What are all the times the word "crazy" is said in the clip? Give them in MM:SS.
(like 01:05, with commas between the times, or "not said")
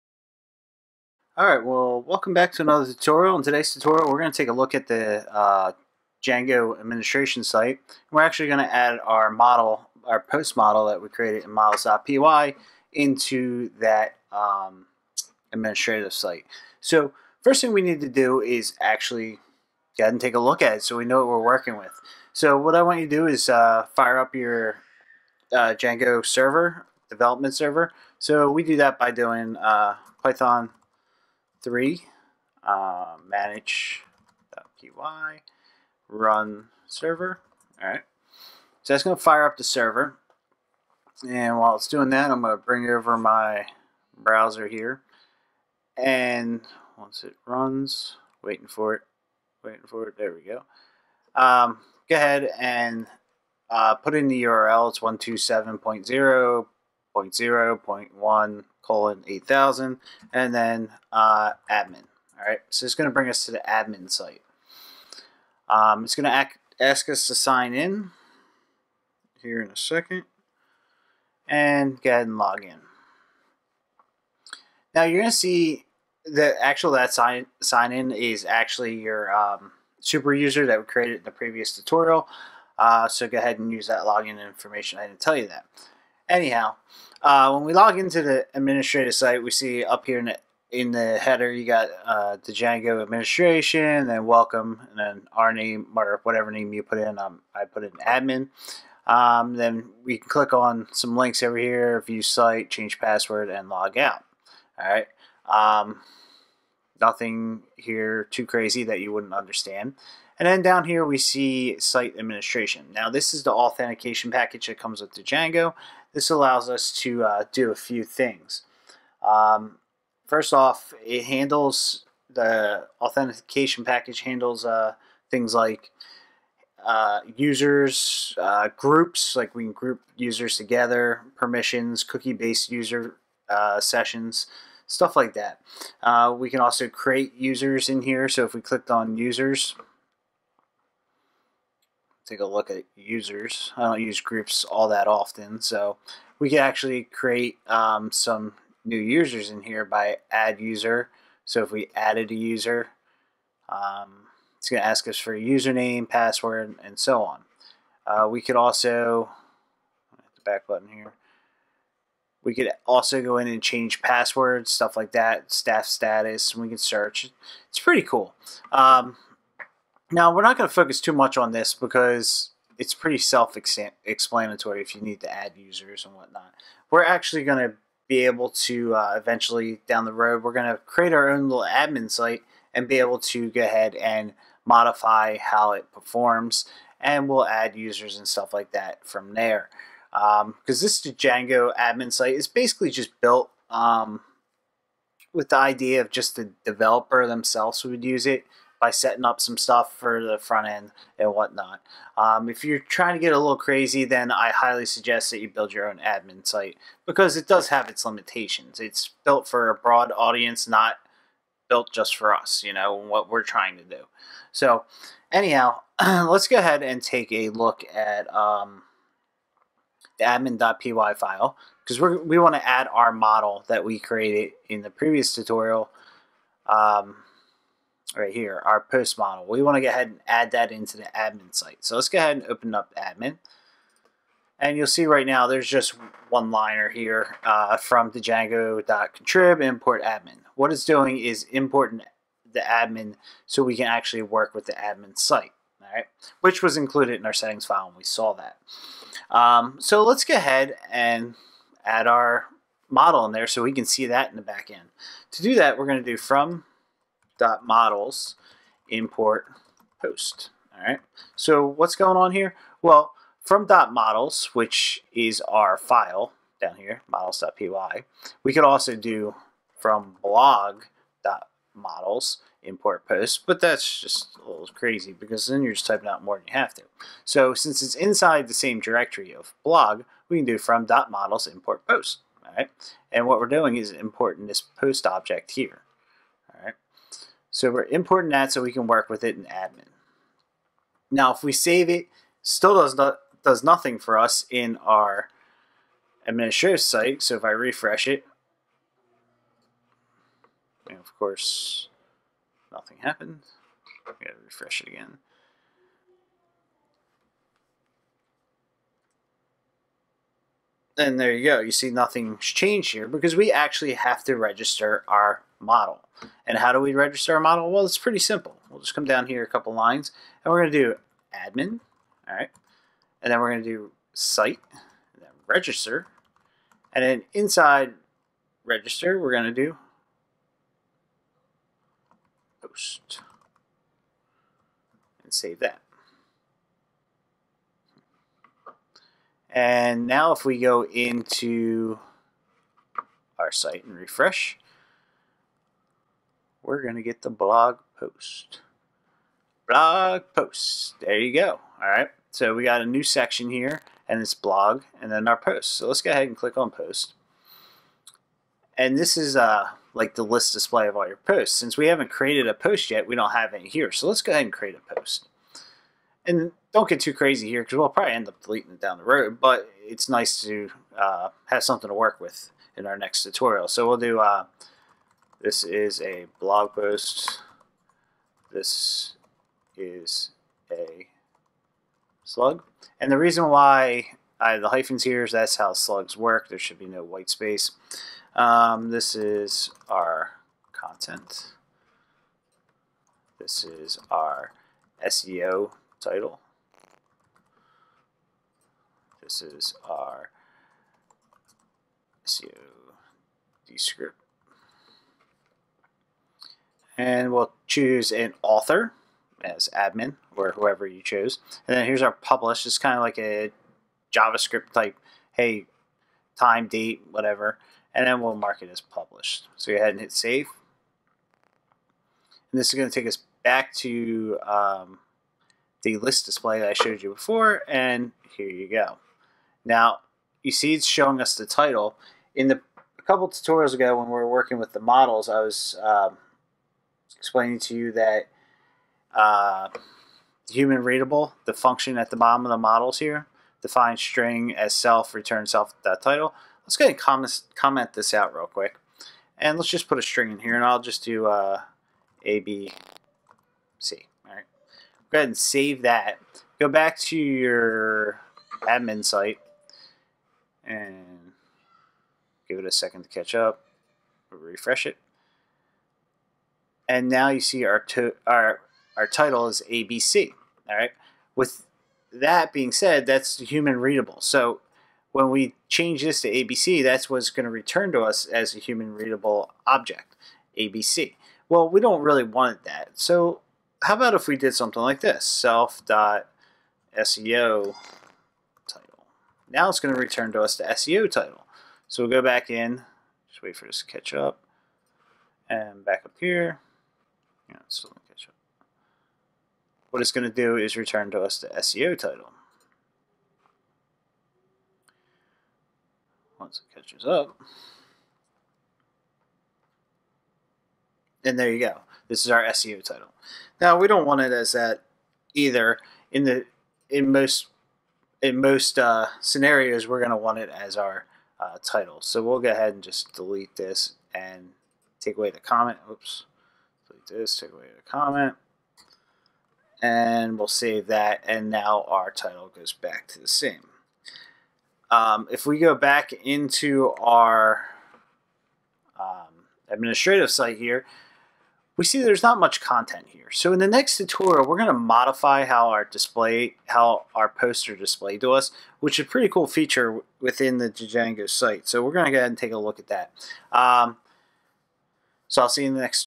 01:48, 03:23, 04:34, 06:07.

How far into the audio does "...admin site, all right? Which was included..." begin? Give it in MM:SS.
04:04.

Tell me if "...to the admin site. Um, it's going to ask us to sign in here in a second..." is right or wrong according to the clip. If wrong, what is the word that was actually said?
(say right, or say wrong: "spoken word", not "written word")
right.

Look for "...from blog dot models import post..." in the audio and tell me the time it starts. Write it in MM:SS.
04:29.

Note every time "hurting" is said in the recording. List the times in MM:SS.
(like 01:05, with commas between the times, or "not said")
not said.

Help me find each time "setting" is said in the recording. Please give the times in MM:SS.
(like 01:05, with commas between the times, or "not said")
03:18, 04:07.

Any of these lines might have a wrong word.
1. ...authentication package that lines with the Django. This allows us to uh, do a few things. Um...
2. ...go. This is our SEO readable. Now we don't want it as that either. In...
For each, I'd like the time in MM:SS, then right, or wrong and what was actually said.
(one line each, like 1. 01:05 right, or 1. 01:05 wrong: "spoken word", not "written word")
1. 01:53 wrong: "comes", not "lines"
2. 08:31 wrong: "title", not "readable".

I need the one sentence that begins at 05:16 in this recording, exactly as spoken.
And how do we register a model?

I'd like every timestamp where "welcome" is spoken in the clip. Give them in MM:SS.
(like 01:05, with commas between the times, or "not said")
00:02, 01:34.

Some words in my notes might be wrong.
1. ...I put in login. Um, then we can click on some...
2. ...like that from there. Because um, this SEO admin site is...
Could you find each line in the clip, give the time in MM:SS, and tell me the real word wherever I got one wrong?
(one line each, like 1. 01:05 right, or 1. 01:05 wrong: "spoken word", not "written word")
1. 01:37 wrong: "admin", not "login"
2. 03:08 wrong: "Django", not "SEO".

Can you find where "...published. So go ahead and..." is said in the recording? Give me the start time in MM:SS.
06:58.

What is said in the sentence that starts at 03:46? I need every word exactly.
Um, right here, our post model.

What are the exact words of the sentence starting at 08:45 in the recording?
Oops this, take away the comment.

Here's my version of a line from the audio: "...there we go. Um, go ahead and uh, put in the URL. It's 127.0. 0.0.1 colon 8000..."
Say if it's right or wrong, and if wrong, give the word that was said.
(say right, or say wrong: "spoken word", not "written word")
right.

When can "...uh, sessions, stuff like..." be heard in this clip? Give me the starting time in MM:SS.
02:13.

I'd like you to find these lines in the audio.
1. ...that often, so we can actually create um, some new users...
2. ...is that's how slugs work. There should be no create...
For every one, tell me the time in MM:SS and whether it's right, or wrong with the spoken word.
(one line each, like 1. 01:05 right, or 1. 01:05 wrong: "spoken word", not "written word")
1. 02:24 right
2. 06:25 wrong: "white", not "create".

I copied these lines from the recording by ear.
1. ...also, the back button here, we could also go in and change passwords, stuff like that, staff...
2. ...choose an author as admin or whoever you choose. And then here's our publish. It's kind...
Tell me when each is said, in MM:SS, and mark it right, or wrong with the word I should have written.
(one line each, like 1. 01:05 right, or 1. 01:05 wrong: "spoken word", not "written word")
1. 02:38 right
2. 06:47 right.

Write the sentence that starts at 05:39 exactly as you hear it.
And now if we go into our site and refresh, we're going to get the blog post.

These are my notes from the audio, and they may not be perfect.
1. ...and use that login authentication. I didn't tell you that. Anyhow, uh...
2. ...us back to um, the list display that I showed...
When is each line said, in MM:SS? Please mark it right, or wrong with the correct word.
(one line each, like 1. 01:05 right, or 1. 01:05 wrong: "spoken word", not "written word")
1. 01:23 wrong: "information", not "authentication"
2. 07:03 right.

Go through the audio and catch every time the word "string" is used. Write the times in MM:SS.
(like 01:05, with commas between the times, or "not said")
07:23, 07:30.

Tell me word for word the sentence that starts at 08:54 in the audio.
Um, if we go back into our um, administrative site here, we see there's not much content here.